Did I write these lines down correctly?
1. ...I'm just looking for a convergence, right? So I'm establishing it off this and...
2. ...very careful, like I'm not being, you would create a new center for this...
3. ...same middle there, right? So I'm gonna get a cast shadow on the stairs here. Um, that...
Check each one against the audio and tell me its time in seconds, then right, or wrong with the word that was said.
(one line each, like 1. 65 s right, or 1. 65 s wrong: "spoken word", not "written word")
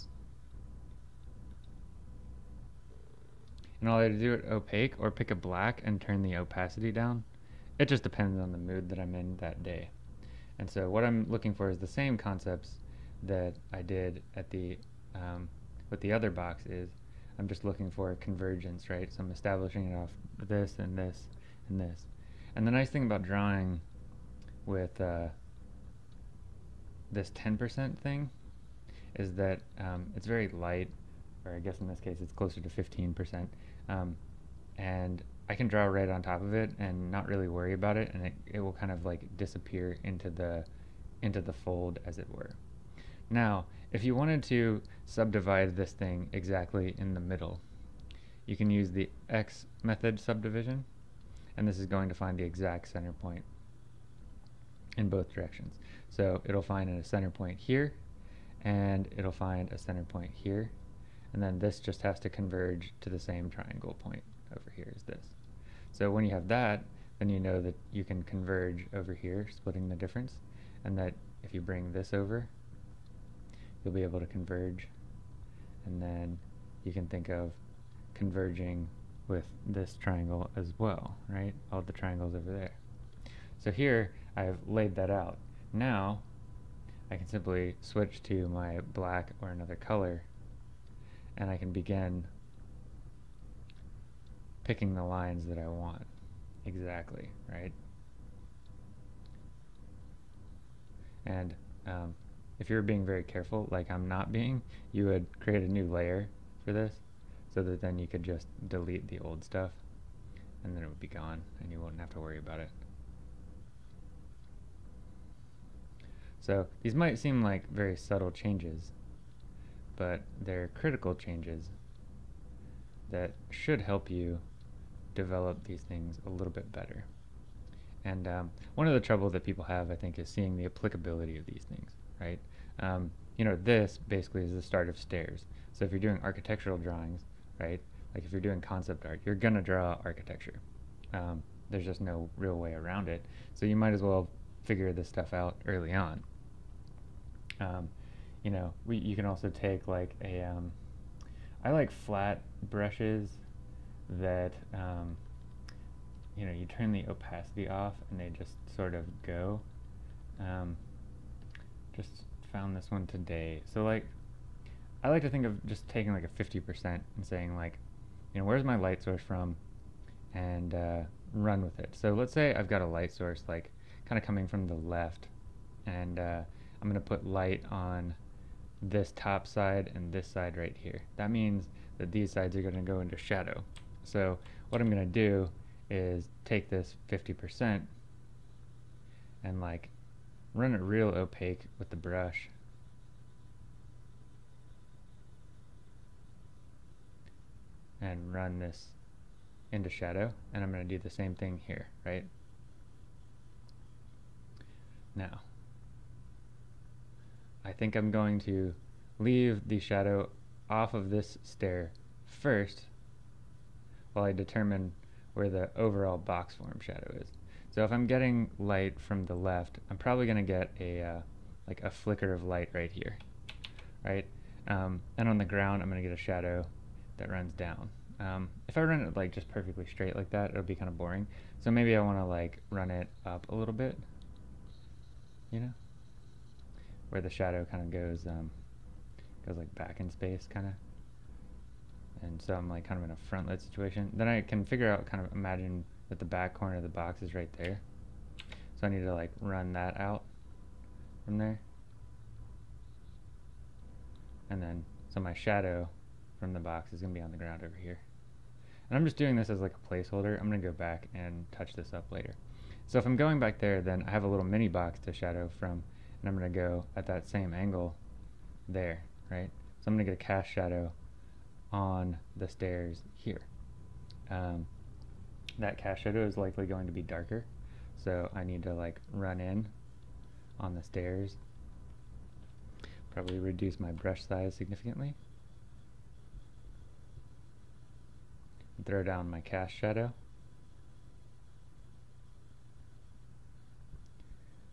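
1. 17 s right
2. 103 s wrong: "layer", not "center"
3. 267 s wrong: "angle", not "middle".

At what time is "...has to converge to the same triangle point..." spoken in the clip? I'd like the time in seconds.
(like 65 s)
62 s.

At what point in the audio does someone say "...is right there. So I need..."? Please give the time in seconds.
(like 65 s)
247 s.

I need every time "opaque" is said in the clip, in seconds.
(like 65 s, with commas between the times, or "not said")
4 s, 191 s.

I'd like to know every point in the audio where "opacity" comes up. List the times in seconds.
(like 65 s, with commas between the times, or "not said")
6 s, 157 s.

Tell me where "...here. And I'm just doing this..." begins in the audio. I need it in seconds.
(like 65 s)
257 s.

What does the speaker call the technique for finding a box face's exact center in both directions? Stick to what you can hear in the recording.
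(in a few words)
x method subdivision.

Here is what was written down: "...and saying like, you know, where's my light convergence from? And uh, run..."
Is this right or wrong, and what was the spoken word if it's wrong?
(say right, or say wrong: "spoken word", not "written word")
wrong: "source", not "convergence".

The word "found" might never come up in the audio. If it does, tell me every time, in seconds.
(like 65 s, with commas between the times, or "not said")
162 s.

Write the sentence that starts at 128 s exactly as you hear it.
And um, one of the trouble that people have, I think, is seeing the applicability of these things right?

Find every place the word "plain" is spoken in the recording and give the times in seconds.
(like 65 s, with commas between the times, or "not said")
not said.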